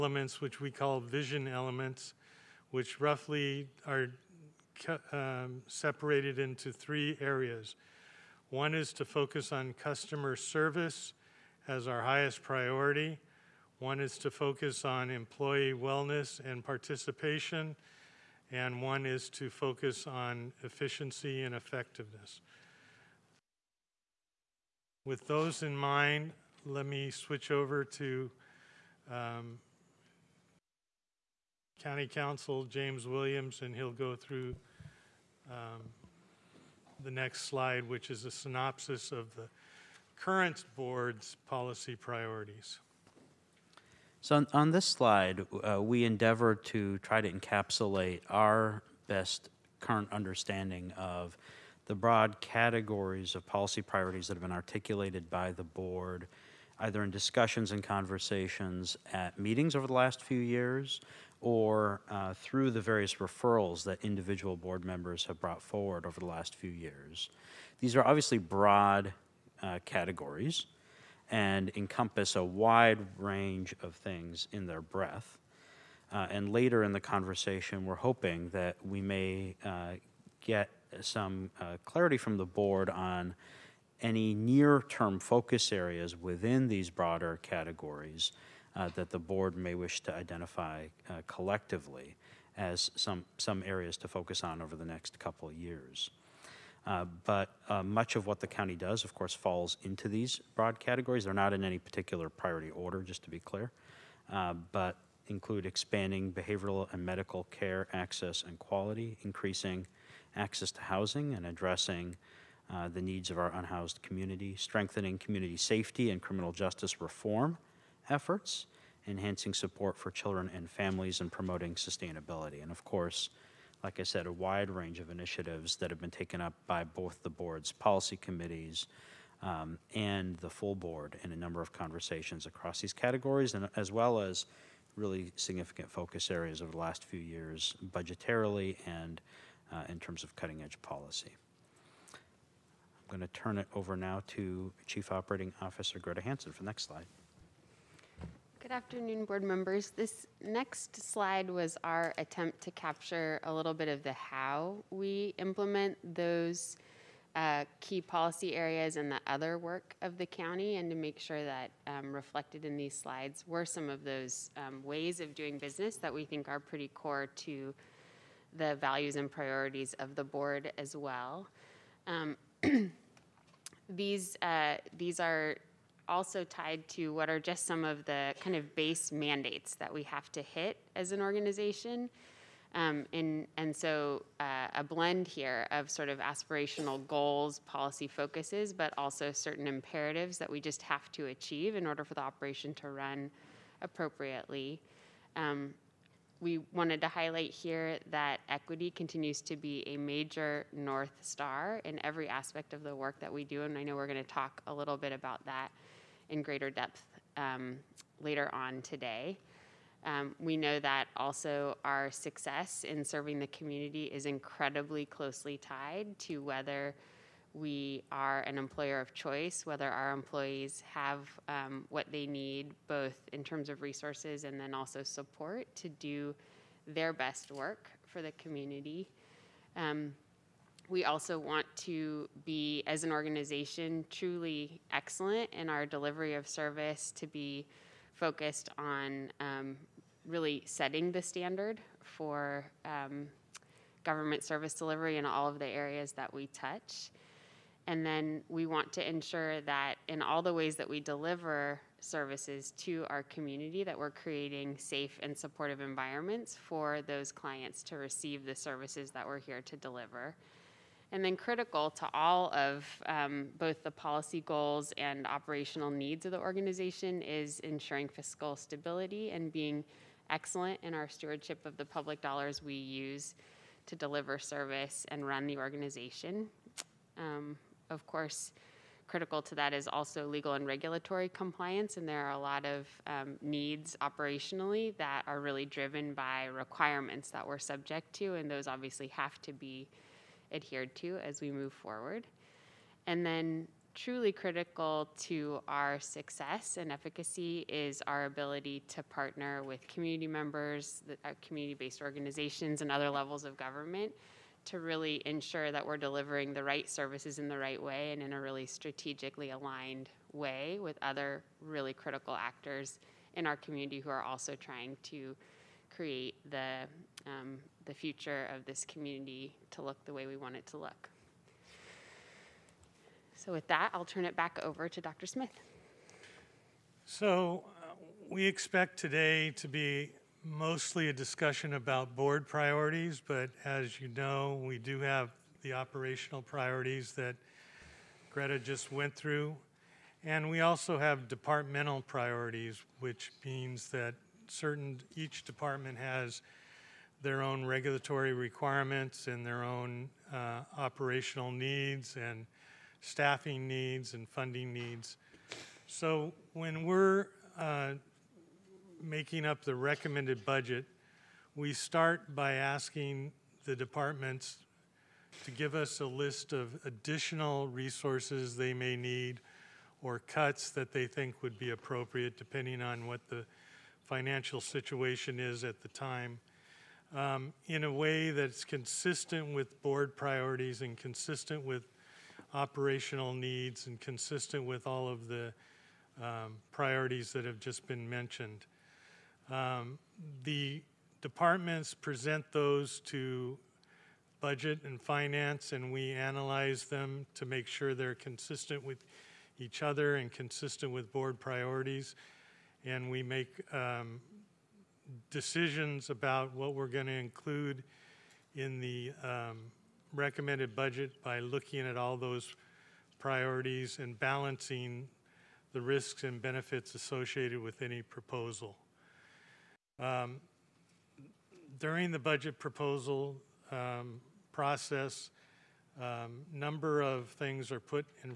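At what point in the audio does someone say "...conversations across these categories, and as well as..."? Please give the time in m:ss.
2:11.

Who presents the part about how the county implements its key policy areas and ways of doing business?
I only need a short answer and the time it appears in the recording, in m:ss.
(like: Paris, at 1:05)
Greta Hansen, at 2:25.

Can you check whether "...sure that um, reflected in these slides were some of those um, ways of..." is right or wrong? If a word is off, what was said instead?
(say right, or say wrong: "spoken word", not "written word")
right.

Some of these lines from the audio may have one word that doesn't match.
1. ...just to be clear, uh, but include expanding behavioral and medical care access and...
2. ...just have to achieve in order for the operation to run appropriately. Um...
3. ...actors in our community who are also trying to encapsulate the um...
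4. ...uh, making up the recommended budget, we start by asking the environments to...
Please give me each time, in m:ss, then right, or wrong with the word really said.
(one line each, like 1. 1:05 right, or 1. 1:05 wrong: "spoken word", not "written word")
1. 1:43 right
2. 3:10 right
3. 5:12 wrong: "create", not "encapsulate"
4. 5:57 wrong: "departments", not "environments".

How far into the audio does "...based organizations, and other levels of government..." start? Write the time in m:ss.
5:01.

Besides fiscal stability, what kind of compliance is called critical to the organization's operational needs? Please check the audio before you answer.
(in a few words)
Legal and regulatory.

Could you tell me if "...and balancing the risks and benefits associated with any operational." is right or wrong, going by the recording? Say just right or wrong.
wrong.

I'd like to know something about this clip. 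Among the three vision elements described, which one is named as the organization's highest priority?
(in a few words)
Customer service.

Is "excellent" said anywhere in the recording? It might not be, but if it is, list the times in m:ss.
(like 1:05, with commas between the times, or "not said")
3:54, 4:30.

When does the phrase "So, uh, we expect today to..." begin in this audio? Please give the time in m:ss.
5:27.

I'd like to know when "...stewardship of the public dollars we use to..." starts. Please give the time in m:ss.
4:31.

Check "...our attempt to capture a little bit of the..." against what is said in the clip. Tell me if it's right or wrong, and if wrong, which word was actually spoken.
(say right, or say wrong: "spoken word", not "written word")
right.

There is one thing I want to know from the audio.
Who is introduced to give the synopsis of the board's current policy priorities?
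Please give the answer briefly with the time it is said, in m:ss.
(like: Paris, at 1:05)
James Williams, at 0:32.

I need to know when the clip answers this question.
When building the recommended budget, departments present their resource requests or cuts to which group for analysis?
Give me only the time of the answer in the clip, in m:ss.
6:34.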